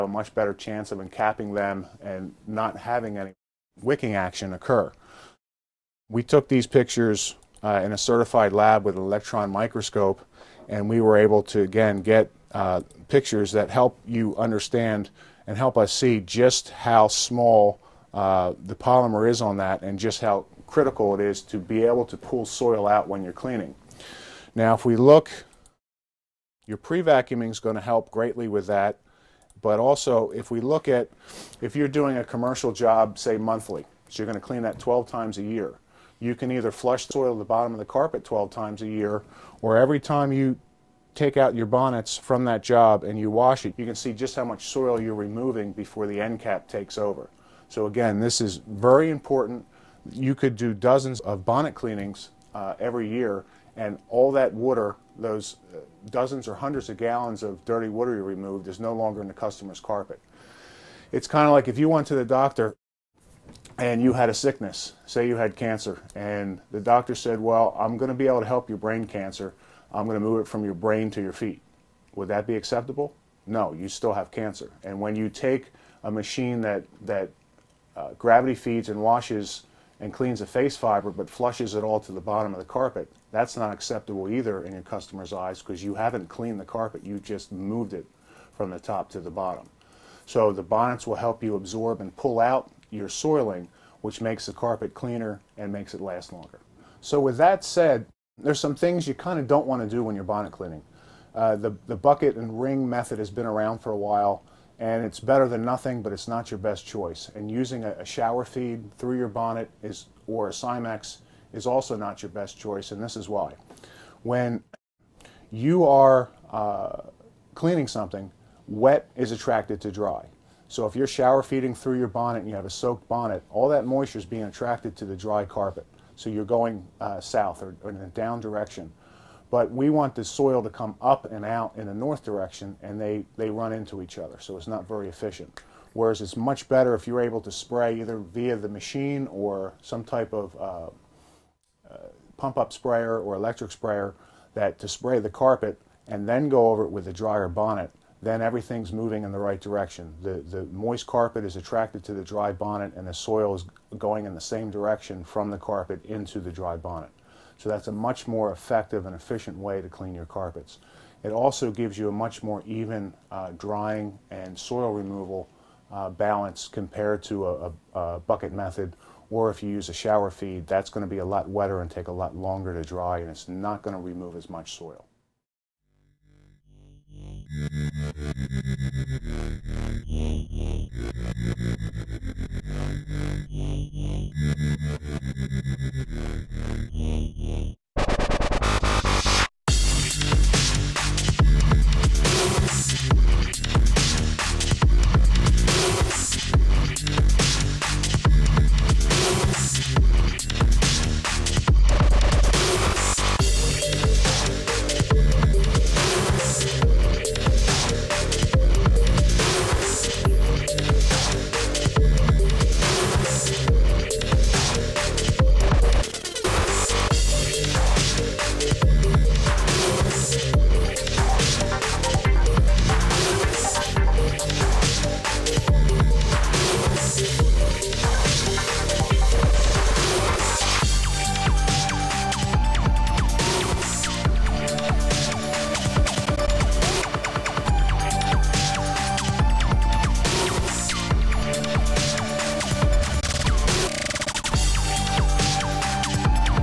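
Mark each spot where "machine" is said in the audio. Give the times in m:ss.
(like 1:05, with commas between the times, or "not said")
1:16, 2:18.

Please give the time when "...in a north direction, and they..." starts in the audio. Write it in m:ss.
2:11.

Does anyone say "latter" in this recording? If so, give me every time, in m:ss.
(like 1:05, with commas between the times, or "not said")
not said.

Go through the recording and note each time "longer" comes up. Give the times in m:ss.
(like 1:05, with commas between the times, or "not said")
0:58, 1:36, 2:52.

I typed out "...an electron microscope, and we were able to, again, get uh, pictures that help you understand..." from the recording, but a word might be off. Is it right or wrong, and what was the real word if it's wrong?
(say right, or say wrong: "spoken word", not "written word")
right.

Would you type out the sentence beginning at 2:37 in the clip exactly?
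So that's a much more effective and efficient way to clean your carpets.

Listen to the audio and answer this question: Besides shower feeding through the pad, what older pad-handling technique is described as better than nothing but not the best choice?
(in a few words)
Bucket and wring method.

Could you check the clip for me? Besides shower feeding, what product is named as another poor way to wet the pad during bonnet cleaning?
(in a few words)
Cimex.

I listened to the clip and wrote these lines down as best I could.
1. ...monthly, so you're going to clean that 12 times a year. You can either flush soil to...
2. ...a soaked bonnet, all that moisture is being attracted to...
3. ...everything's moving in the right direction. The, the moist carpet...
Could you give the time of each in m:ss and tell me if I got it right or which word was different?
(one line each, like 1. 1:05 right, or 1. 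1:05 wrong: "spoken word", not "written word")
1. 0:33 right
2. 2:02 right
3. 2:28 right.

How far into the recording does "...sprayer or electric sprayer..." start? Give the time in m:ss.
2:22.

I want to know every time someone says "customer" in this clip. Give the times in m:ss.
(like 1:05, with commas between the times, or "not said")
0:59, 1:24.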